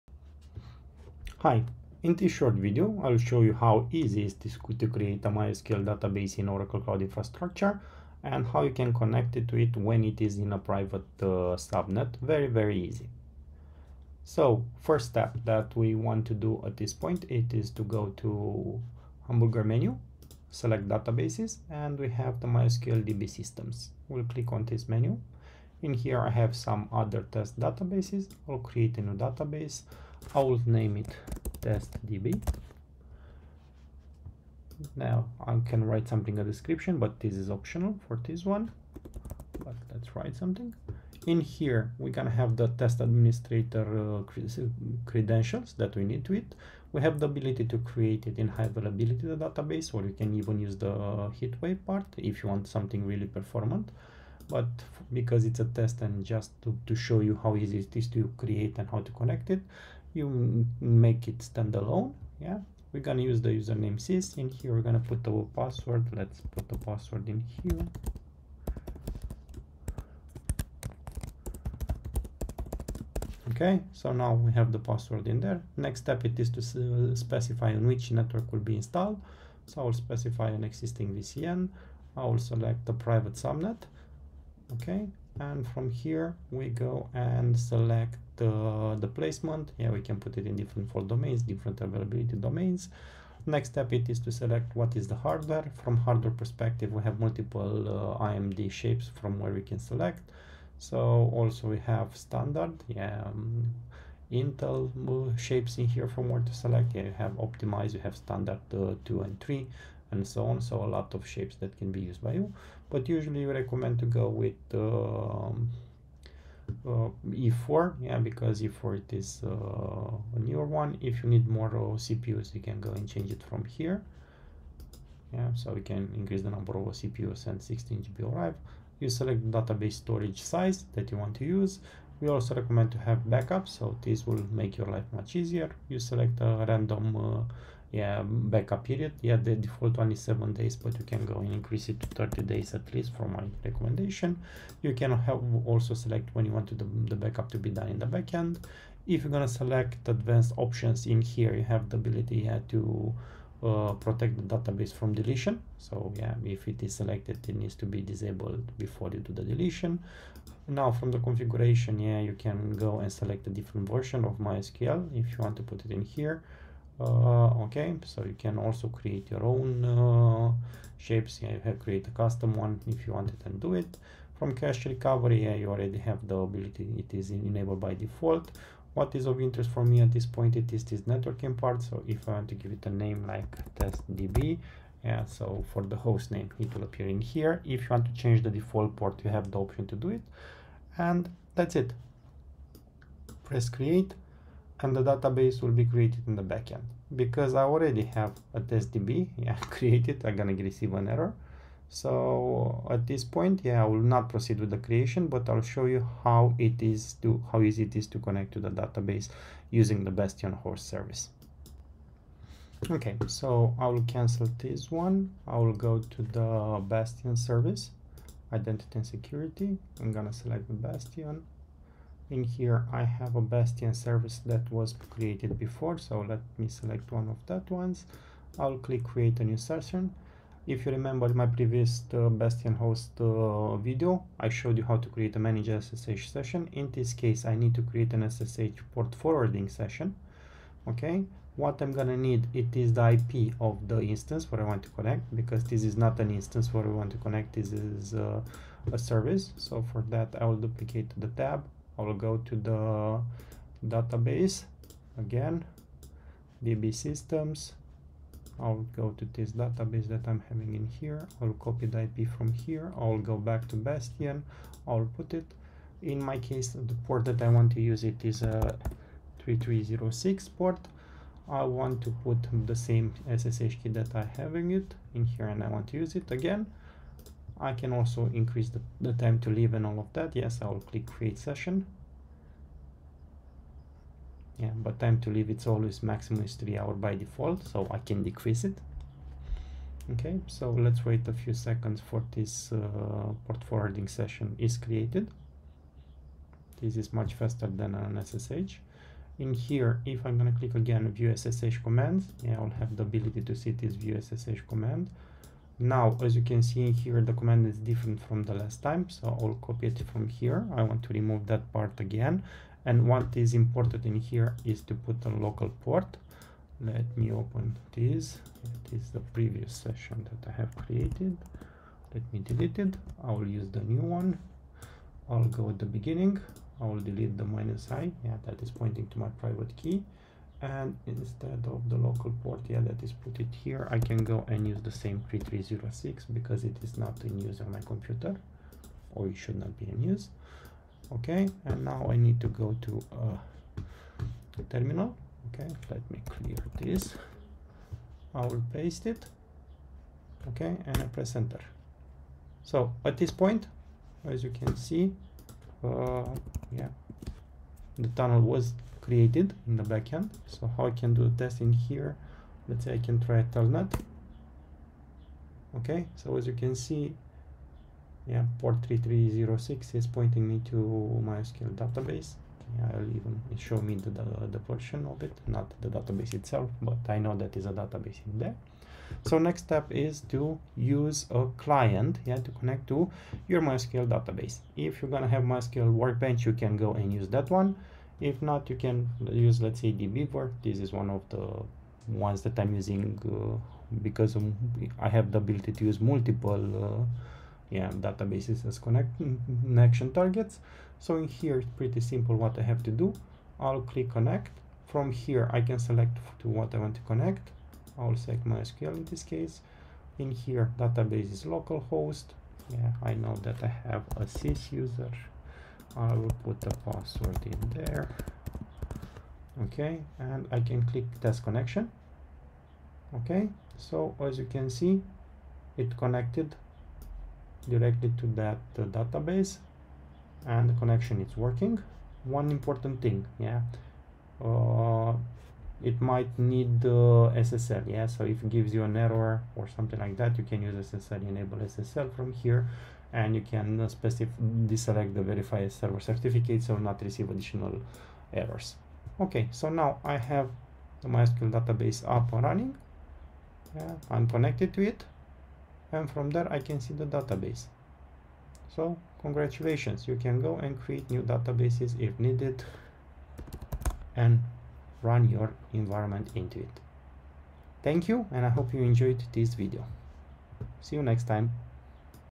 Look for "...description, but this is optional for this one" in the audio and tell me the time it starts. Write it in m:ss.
0:36.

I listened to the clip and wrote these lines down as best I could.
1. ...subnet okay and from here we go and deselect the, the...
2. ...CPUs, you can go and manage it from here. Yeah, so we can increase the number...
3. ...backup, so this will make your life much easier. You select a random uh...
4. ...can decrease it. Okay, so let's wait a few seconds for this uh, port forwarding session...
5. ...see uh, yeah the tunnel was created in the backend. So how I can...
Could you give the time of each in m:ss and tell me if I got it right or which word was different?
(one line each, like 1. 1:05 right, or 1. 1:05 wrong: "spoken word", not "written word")
1. 1:23 wrong: "select", not "deselect"
2. 2:01 wrong: "change", not "manage"
3. 2:13 right
4. 4:47 right
5. 5:54 right.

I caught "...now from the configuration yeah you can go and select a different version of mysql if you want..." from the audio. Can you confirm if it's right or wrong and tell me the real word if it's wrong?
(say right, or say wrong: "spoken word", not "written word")
right.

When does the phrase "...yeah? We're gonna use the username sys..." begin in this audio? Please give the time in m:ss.
1:02.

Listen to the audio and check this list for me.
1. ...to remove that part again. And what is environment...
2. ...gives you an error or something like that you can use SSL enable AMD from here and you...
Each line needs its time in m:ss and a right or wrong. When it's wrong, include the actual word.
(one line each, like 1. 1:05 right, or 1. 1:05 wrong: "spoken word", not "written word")
1. 5:11 wrong: "important", not "environment"
2. 7:18 wrong: "SSL", not "AMD".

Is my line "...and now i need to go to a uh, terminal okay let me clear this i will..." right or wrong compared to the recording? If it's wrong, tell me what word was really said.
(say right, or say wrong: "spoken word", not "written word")
right.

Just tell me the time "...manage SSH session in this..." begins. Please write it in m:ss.
3:55.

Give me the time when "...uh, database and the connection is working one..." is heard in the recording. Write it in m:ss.
7:08.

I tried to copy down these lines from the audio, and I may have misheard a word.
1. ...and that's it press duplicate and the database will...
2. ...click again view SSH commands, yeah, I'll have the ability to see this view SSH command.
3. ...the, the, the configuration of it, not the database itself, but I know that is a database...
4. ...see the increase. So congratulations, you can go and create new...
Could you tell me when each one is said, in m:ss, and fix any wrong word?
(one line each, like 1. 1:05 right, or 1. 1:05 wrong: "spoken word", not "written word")
1. 3:10 wrong: "create", not "duplicate"
2. 5:00 right
3. 6:13 wrong: "version", not "configuration"
4. 7:36 wrong: "database", not "increase".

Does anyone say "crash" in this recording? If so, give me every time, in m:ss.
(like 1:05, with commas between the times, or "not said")
2:54.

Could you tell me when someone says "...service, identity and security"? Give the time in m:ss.
3:37.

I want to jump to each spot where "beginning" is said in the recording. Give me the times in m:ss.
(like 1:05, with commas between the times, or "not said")
5:25.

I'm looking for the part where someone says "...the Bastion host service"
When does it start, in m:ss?
3:30.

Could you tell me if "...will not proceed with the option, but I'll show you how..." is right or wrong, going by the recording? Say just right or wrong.
wrong.